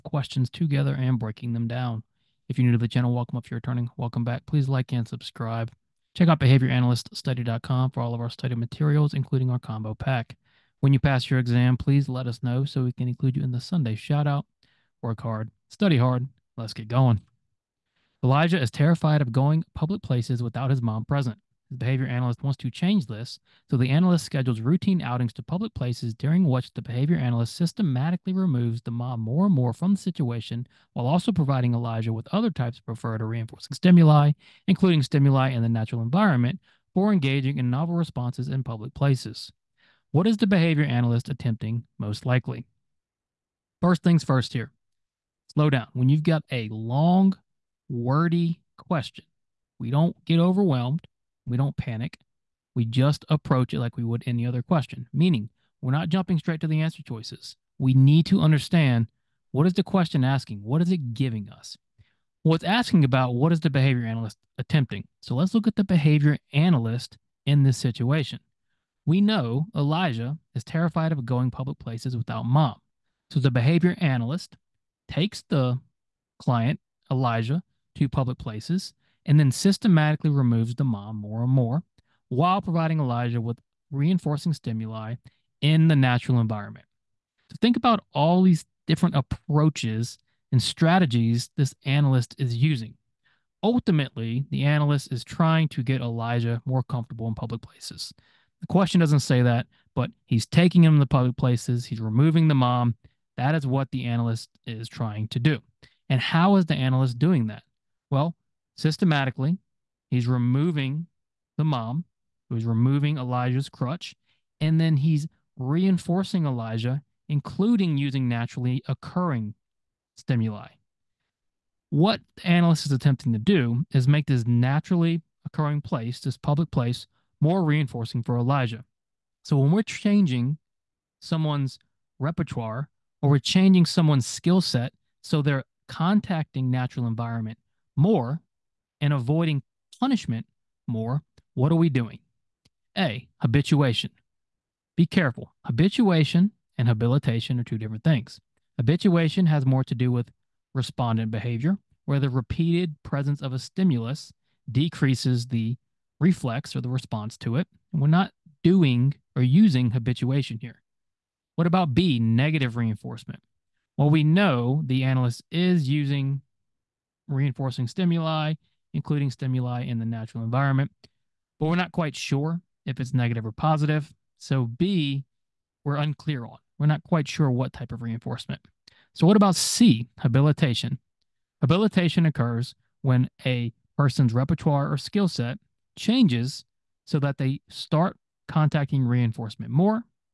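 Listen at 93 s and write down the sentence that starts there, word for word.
Ultimately, the analyst is trying to get Elijah more comfortable in public places.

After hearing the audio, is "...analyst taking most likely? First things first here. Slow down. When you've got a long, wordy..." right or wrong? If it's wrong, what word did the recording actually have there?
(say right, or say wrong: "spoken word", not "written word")
wrong: "attempting", not "taking".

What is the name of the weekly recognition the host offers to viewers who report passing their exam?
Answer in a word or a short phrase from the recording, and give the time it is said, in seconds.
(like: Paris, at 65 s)
Sunday shout out, at 13 s.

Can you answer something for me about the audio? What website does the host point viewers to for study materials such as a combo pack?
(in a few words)
behavioranalyststudy.com.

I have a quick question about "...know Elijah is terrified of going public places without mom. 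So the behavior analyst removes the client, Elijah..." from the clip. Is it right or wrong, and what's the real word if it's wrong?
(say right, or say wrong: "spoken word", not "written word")
wrong: "takes", not "removes".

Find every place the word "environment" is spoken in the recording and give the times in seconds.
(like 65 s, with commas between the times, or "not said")
36 s, 86 s, 137 s, 170 s.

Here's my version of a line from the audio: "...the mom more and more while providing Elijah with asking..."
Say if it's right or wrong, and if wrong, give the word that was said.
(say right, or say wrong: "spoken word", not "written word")
wrong: "reinforcing", not "asking".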